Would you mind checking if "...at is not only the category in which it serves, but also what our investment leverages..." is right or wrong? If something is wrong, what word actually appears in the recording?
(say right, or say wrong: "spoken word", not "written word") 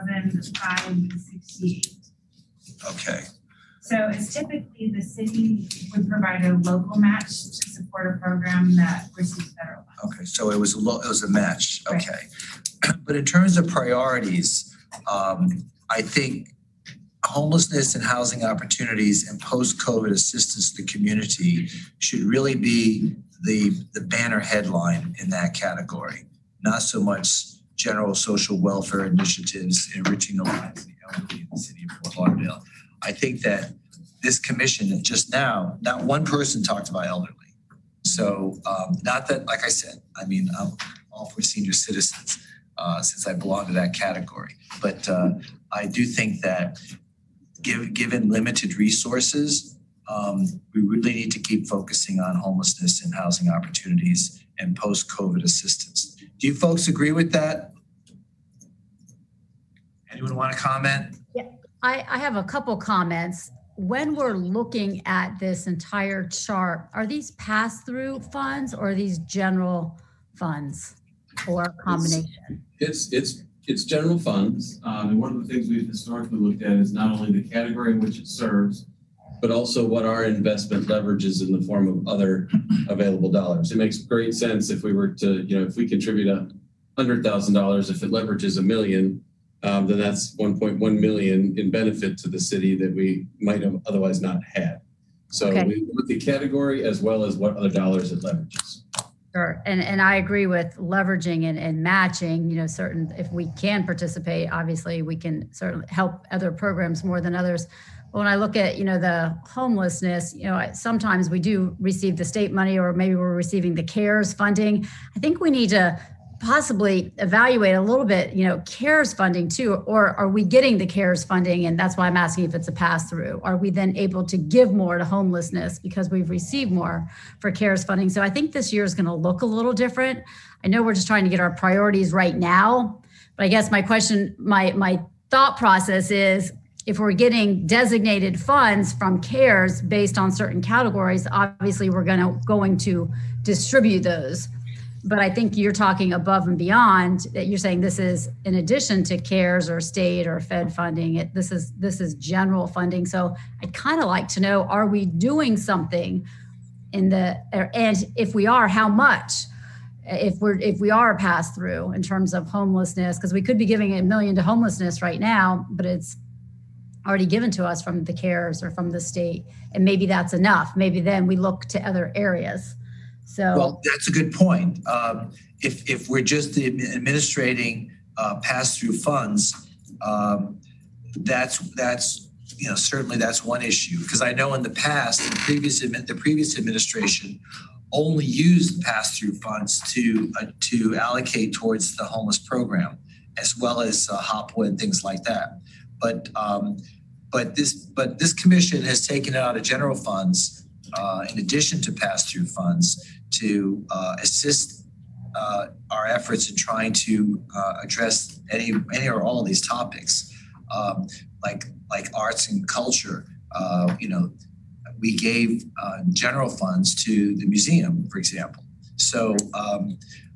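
right.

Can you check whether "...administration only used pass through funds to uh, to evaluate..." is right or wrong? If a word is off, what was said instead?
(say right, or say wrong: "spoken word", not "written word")
wrong: "allocate", not "evaluate".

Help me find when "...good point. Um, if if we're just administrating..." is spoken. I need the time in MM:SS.
02:54.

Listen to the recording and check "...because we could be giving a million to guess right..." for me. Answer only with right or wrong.
wrong.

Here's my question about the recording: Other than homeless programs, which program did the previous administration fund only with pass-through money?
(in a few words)
HOPWA.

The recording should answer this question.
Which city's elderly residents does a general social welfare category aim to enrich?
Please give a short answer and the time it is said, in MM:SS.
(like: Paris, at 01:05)
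Fort Lauderdale, at 00:32.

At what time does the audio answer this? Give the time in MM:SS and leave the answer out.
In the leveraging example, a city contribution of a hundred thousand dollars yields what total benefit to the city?
01:30.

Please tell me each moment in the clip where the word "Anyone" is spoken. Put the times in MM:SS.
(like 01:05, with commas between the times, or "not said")
01:00.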